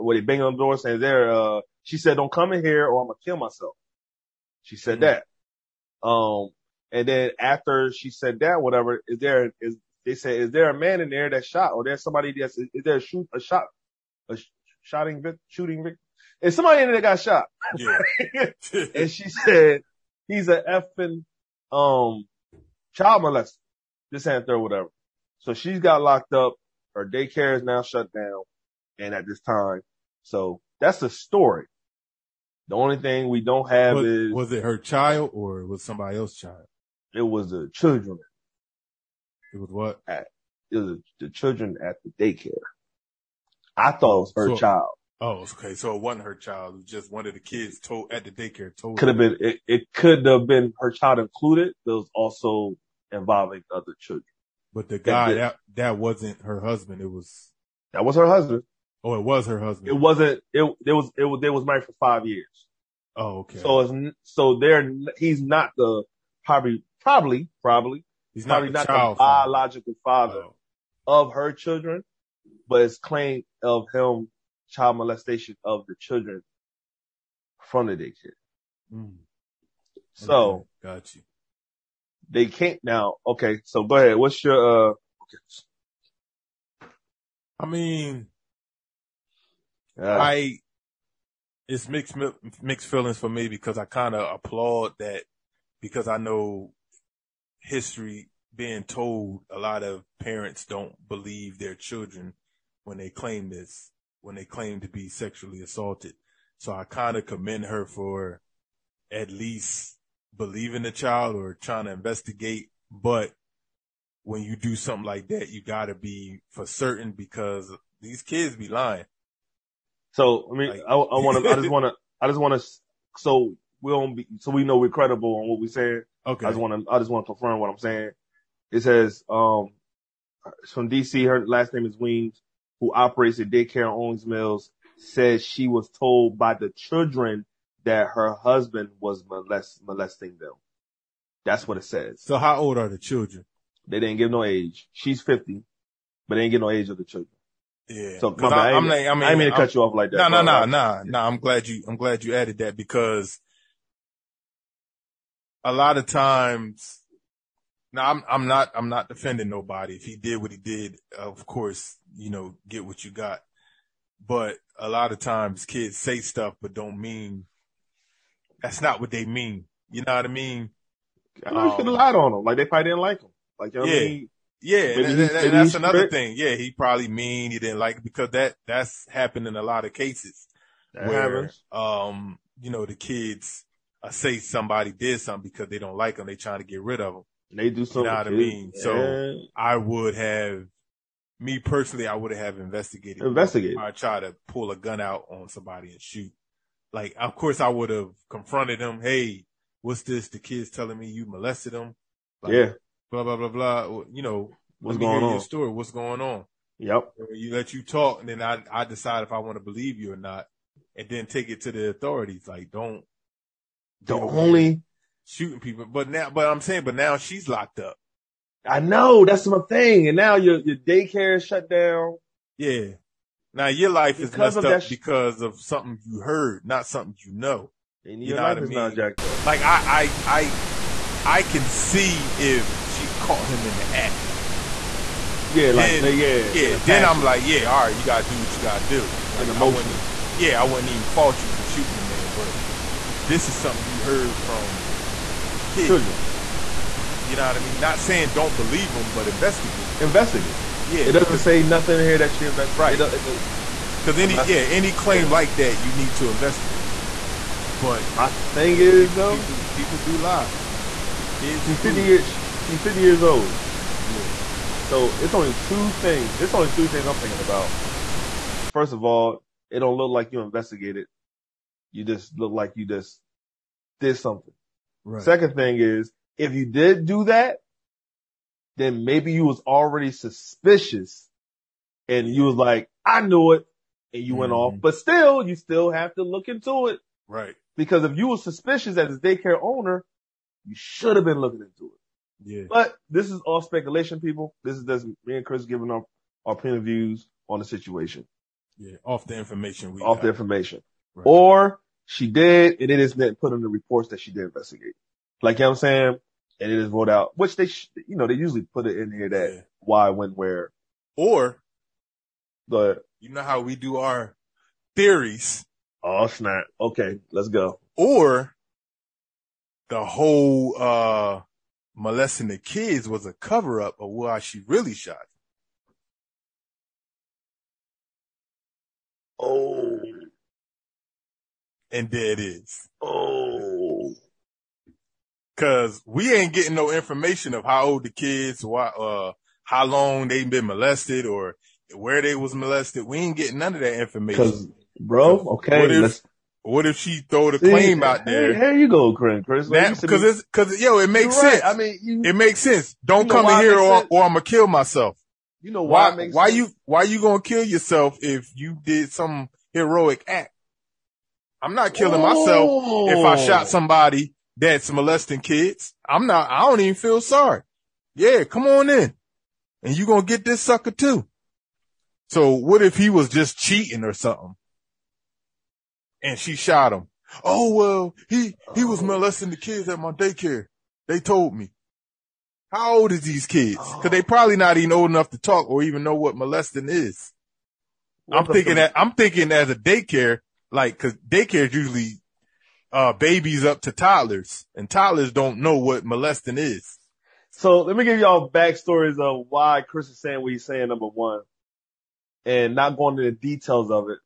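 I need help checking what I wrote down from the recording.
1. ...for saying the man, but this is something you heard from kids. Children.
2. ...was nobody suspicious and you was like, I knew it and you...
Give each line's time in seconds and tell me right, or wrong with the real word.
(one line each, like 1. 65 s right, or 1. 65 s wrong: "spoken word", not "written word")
1. 241 s wrong: "shooting", not "saying"
2. 279 s wrong: "already", not "nobody".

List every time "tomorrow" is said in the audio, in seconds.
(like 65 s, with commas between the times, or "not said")
not said.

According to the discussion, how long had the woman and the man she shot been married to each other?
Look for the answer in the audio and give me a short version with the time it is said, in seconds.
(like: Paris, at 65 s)
5 years, at 62 s.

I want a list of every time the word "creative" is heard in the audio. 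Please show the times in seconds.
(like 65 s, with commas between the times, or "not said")
not said.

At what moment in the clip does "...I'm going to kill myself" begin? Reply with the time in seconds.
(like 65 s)
3 s.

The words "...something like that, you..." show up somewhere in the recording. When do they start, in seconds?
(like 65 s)
114 s.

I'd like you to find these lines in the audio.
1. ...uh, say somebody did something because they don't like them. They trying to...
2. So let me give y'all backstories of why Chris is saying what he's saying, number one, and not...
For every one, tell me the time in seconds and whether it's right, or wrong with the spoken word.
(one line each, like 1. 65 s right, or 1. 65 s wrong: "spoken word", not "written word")
1. 184 s right
2. 397 s right.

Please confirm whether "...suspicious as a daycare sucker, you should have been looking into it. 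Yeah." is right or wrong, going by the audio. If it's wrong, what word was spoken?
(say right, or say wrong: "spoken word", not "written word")
wrong: "owner", not "sucker".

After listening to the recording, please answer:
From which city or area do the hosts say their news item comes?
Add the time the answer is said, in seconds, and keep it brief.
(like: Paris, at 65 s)
DC, at 130 s.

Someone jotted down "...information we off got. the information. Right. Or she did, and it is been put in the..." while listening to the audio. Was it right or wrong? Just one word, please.
right.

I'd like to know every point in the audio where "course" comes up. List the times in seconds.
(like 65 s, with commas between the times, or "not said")
161 s, 197 s.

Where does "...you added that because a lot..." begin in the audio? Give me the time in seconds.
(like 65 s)
152 s.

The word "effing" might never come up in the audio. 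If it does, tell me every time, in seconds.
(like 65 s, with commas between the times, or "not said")
20 s.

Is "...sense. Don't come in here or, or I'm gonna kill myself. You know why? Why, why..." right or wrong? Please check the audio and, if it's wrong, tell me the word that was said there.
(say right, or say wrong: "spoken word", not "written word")
right.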